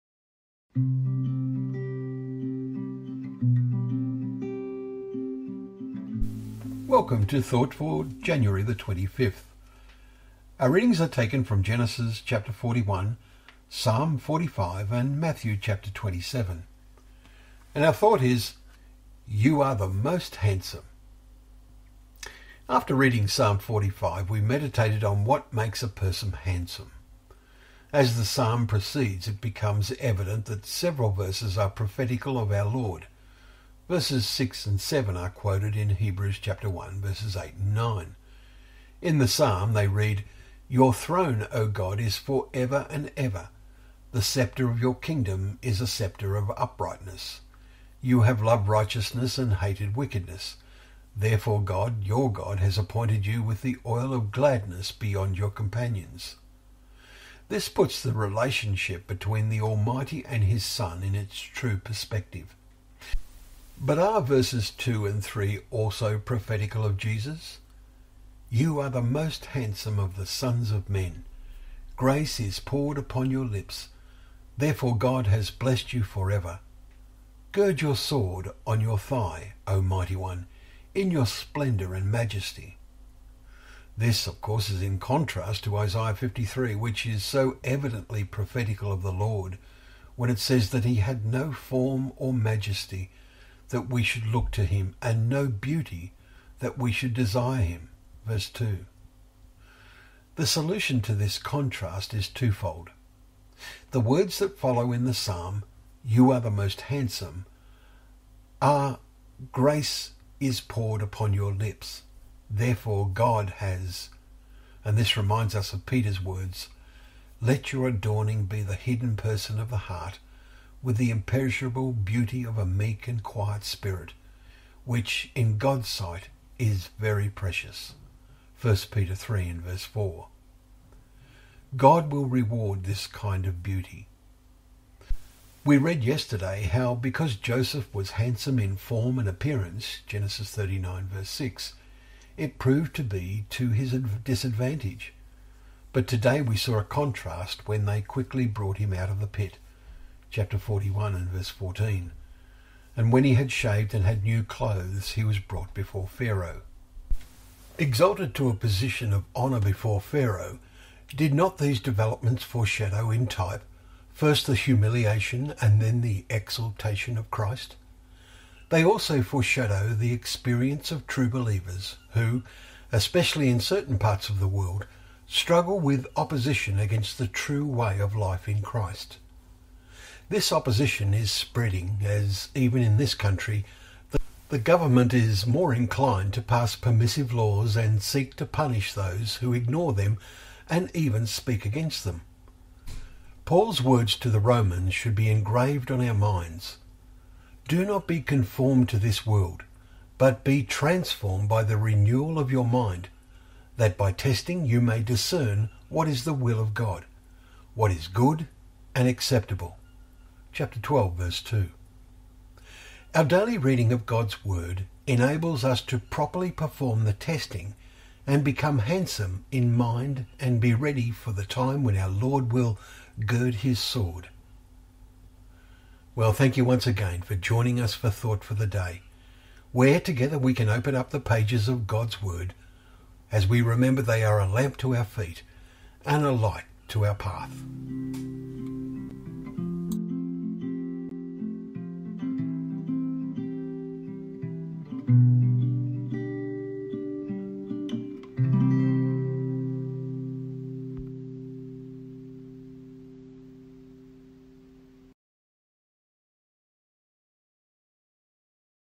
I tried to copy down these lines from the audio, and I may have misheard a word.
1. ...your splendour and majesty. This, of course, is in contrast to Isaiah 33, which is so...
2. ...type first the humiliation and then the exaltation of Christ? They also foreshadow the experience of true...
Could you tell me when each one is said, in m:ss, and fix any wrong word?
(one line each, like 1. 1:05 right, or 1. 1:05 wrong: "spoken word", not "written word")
1. 1:21 wrong: "53", not "33"
2. 2:43 right.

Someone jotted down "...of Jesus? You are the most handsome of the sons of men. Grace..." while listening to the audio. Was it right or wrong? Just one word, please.
right.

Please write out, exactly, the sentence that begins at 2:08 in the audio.
1 Peter 3 and verse 4.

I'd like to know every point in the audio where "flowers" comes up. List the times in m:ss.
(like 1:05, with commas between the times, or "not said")
not said.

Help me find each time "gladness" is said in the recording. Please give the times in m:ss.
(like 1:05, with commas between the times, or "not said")
0:54.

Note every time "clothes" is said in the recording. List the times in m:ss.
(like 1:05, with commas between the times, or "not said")
2:34.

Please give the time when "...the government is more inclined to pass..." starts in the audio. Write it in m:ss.
3:04.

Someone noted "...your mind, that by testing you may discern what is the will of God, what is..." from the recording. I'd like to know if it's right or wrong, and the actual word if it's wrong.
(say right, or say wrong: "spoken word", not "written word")
right.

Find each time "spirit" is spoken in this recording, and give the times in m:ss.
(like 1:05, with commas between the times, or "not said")
2:03.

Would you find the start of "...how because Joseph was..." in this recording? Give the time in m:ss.
2:16.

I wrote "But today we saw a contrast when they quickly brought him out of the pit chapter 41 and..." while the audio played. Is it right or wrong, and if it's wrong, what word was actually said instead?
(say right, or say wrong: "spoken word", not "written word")
right.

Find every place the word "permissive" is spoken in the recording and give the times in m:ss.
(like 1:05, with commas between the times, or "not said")
3:06.